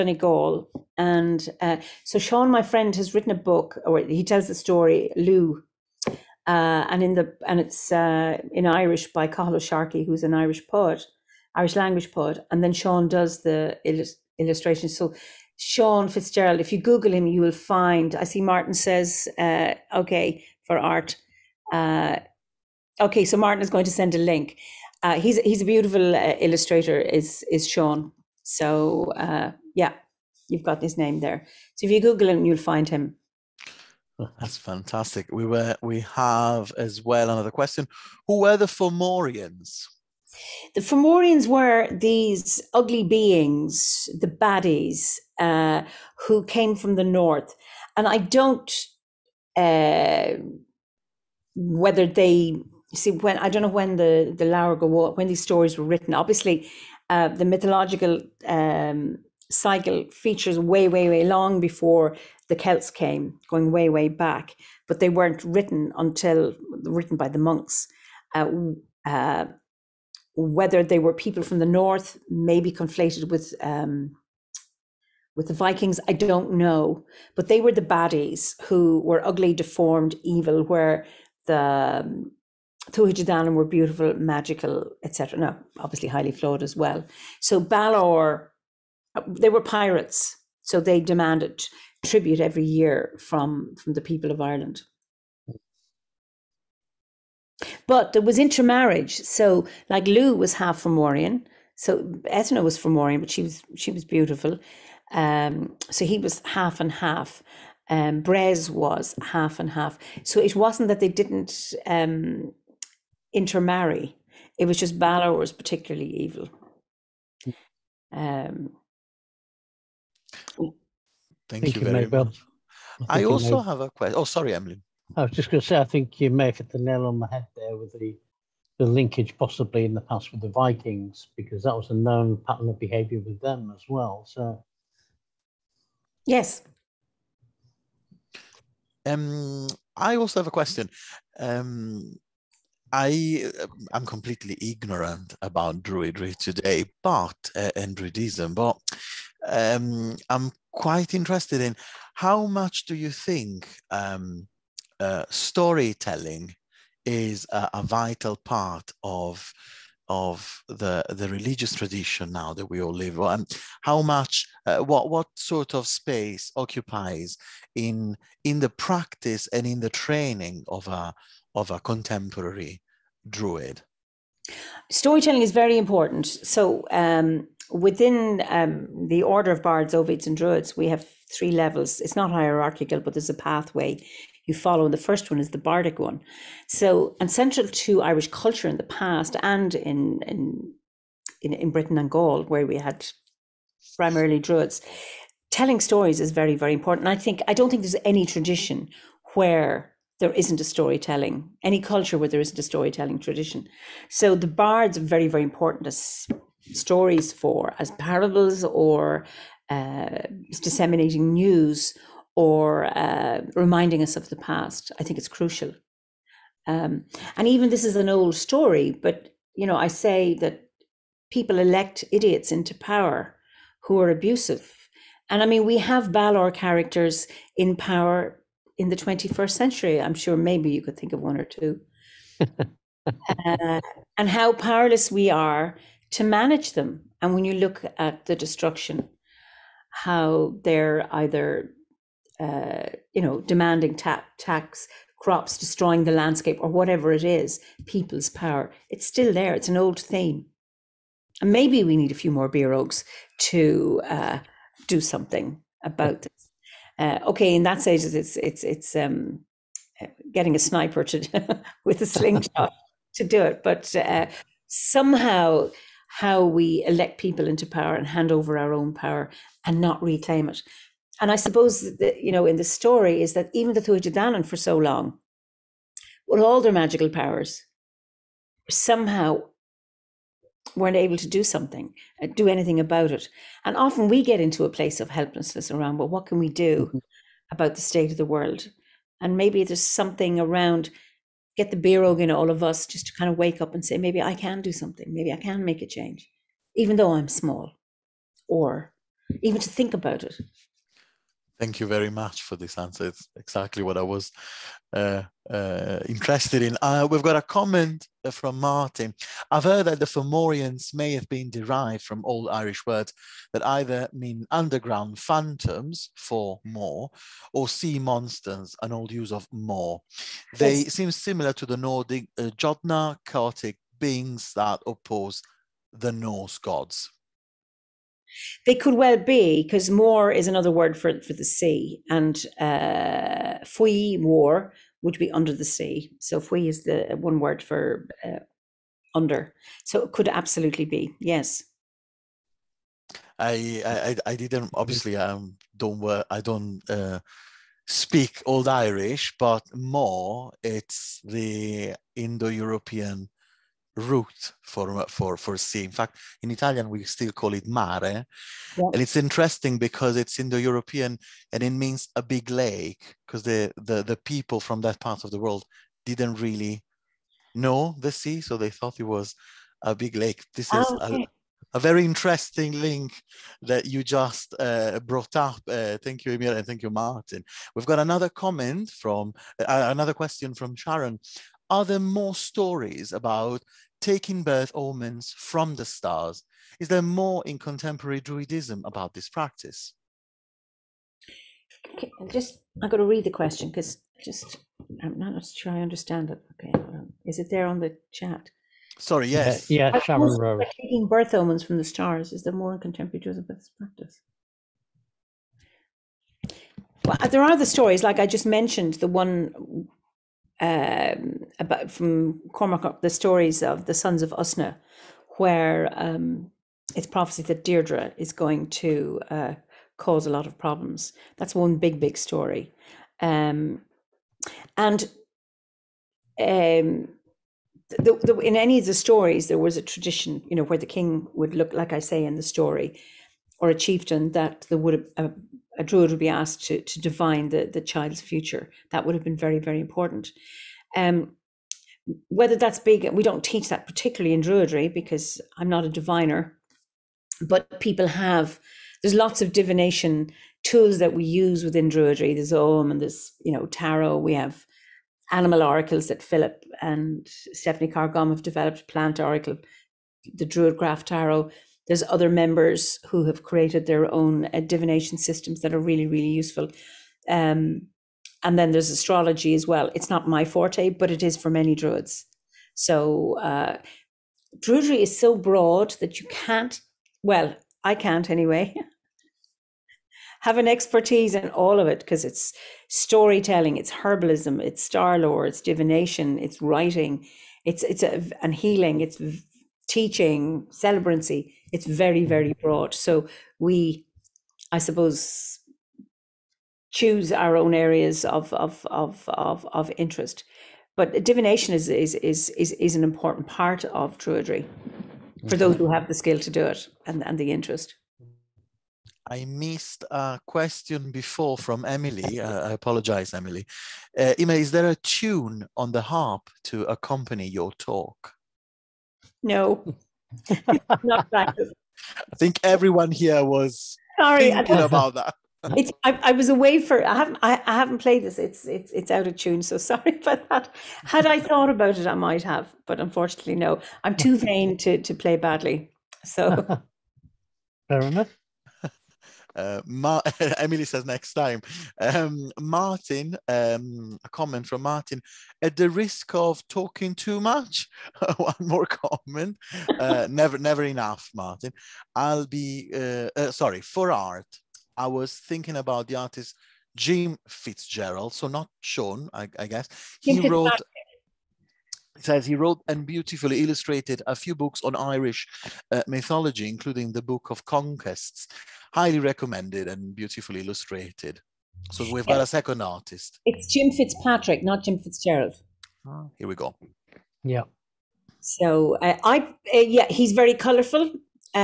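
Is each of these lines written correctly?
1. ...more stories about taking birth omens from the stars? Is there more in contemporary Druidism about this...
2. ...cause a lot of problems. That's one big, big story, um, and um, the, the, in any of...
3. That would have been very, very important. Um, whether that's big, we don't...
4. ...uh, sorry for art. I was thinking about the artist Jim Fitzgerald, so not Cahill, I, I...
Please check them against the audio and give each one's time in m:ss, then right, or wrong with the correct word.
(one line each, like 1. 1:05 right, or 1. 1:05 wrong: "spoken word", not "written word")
1. 6:21 right
2. 6:59 right
3. 7:18 right
4. 9:13 wrong: "Sean", not "Cahill".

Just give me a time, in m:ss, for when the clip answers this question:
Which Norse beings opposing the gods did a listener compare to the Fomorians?
5:22.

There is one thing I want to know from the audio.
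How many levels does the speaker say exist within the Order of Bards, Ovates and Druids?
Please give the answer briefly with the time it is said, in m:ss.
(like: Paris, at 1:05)
3, at 3:01.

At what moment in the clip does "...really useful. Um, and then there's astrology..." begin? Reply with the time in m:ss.
7:46.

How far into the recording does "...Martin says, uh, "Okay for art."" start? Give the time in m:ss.
0:18.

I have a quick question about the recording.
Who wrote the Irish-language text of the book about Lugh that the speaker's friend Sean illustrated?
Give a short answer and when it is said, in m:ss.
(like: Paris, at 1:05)
Cahill Sharkey, at 0:09.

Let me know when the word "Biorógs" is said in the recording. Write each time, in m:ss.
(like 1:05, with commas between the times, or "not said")
4:12, 4:51.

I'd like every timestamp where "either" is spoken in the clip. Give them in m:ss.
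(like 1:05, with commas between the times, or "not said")
4:01, 5:13.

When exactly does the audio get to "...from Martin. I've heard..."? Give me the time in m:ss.
5:08.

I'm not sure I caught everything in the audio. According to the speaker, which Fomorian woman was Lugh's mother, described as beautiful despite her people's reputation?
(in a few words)
Ethna.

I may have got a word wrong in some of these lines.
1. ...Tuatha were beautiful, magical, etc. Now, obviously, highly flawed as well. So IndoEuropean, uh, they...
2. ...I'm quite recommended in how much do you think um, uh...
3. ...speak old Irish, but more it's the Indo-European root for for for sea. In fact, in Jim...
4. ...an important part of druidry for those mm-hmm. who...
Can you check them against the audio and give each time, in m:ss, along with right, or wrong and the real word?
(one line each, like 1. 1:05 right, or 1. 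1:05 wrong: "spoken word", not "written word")
1. 1:22 wrong: "Balor", not "IndoEuropean"
2. 2:30 wrong: "interested", not "recommended"
3. 5:47 wrong: "Italian", not "Jim"
4. 8:22 right.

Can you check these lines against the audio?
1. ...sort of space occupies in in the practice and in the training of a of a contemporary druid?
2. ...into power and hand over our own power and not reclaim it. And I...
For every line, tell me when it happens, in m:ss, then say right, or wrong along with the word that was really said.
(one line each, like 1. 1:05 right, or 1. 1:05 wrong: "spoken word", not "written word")
1. 2:45 right
2. 4:27 right.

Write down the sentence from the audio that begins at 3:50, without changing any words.
I'm sure maybe you could think of one or two.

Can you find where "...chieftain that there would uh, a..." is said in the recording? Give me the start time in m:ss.
7:13.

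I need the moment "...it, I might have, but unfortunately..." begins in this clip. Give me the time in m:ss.
8:51.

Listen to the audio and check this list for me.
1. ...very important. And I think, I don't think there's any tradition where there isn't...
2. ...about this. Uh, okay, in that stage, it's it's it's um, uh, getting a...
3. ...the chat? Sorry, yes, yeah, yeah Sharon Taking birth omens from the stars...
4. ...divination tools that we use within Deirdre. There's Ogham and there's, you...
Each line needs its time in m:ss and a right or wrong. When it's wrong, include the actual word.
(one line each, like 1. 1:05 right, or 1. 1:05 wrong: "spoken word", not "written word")
1. 3:16 right
2. 4:15 right
3. 6:37 right
4. 7:29 wrong: "Druidry", not "Deirdre".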